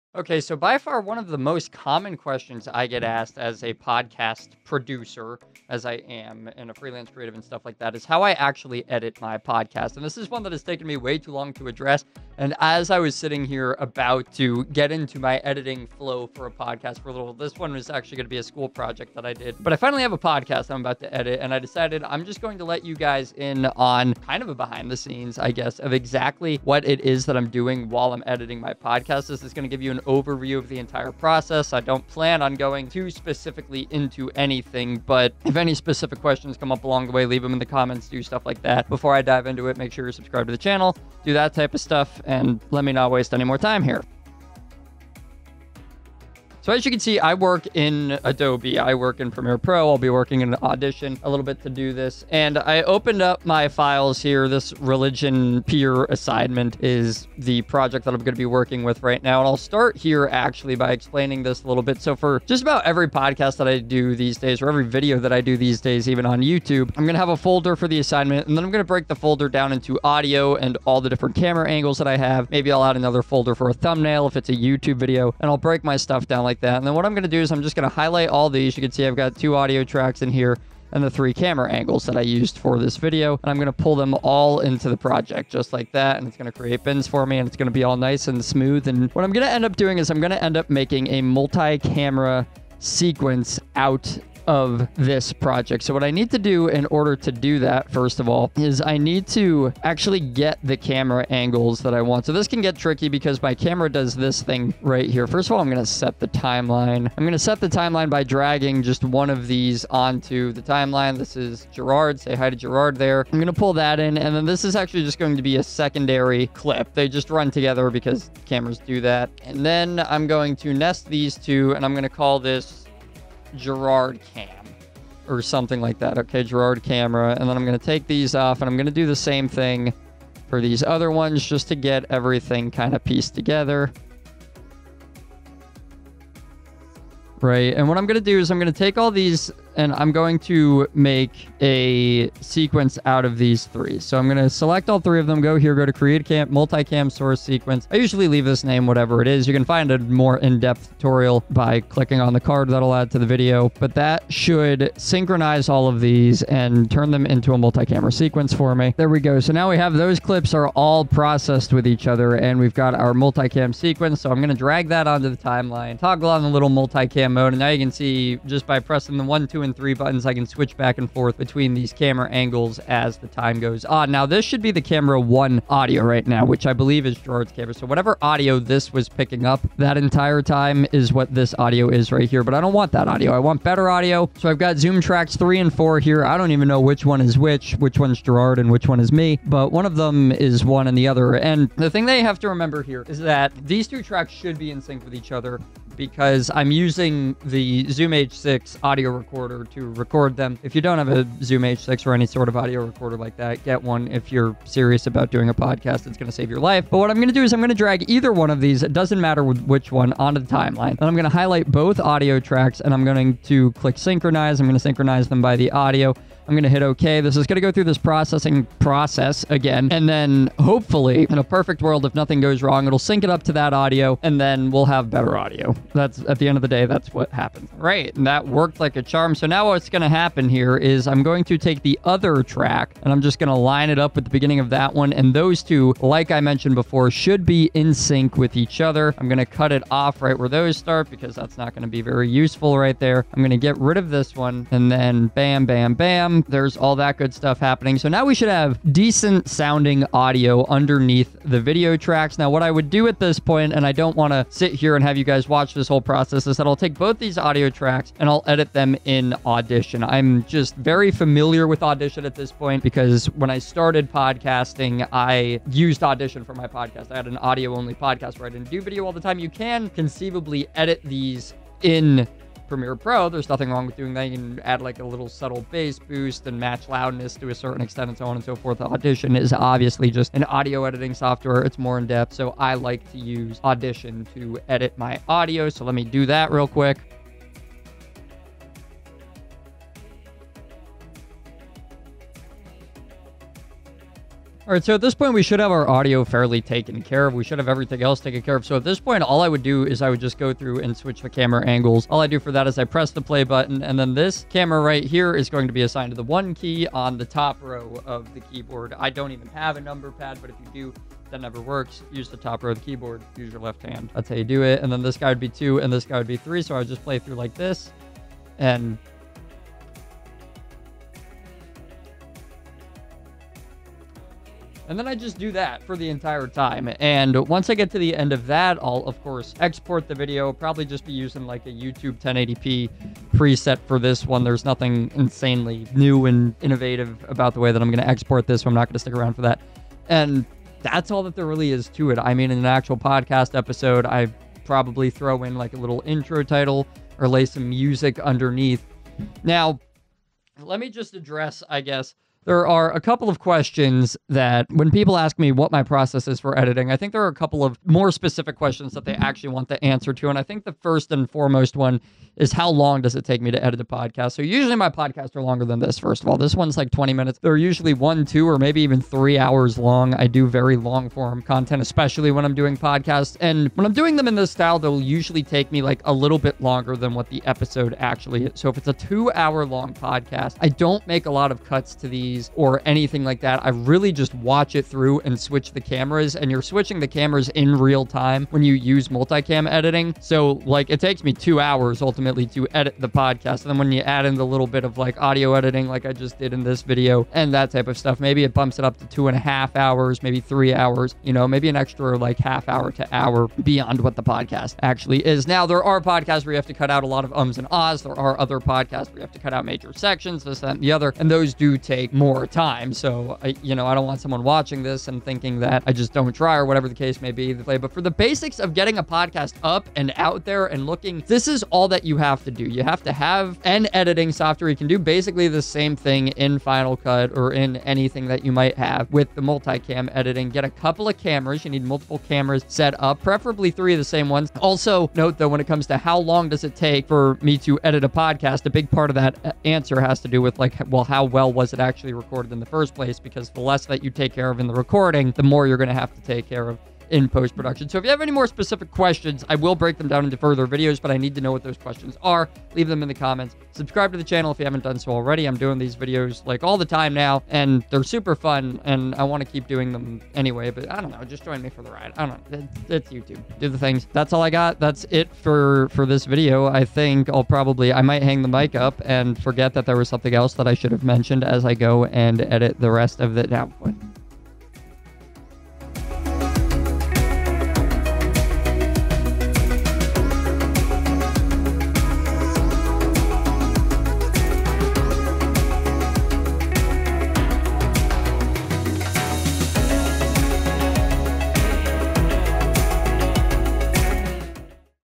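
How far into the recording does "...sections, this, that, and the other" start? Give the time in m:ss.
6:49.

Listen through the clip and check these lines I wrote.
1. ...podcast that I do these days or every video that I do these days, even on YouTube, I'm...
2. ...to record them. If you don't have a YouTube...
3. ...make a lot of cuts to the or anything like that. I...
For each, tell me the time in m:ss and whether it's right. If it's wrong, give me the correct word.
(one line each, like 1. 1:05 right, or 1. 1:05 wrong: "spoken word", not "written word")
1. 1:03 right
2. 3:19 wrong: "Zoom", not "YouTube"
3. 6:21 right.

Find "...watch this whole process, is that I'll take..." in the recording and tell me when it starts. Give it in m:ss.
4:15.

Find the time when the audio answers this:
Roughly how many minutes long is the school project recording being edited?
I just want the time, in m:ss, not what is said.
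6:06.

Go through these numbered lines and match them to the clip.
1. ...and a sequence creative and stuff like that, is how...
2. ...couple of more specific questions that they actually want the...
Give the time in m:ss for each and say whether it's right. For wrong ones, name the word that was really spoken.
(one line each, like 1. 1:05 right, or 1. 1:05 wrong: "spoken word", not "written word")
1. 0:06 wrong: "freelance", not "sequence"
2. 5:57 right.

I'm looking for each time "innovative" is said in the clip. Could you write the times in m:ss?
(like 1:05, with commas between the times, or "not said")
5:36.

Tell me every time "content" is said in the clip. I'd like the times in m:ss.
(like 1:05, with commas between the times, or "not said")
6:11.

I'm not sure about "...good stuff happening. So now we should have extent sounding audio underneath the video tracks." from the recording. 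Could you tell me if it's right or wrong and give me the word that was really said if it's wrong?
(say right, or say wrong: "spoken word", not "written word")
wrong: "decent", not "extent".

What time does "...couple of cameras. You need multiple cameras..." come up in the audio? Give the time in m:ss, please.
7:10.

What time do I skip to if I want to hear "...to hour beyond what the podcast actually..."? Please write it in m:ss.
6:42.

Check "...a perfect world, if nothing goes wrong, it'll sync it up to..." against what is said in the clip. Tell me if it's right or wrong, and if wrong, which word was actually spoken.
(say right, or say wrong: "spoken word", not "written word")
right.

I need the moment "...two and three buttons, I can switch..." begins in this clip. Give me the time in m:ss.
2:49.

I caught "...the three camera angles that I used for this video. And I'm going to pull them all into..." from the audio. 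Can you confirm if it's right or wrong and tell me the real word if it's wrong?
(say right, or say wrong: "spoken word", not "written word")
right.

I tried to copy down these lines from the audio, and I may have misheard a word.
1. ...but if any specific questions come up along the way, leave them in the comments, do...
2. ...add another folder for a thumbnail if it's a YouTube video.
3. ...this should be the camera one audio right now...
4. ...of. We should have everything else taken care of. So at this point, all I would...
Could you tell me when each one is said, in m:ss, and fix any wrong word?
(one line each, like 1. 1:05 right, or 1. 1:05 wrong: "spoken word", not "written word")
1. 0:35 right
2. 1:12 right
3. 2:54 right
4. 4:57 right.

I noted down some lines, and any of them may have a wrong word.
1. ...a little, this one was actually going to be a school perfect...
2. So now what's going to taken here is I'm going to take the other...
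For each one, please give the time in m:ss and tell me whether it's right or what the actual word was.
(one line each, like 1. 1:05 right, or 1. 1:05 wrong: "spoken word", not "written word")
1. 0:17 wrong: "project", not "perfect"
2. 3:49 wrong: "happen", not "taken".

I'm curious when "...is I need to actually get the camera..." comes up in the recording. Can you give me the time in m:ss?
1:38.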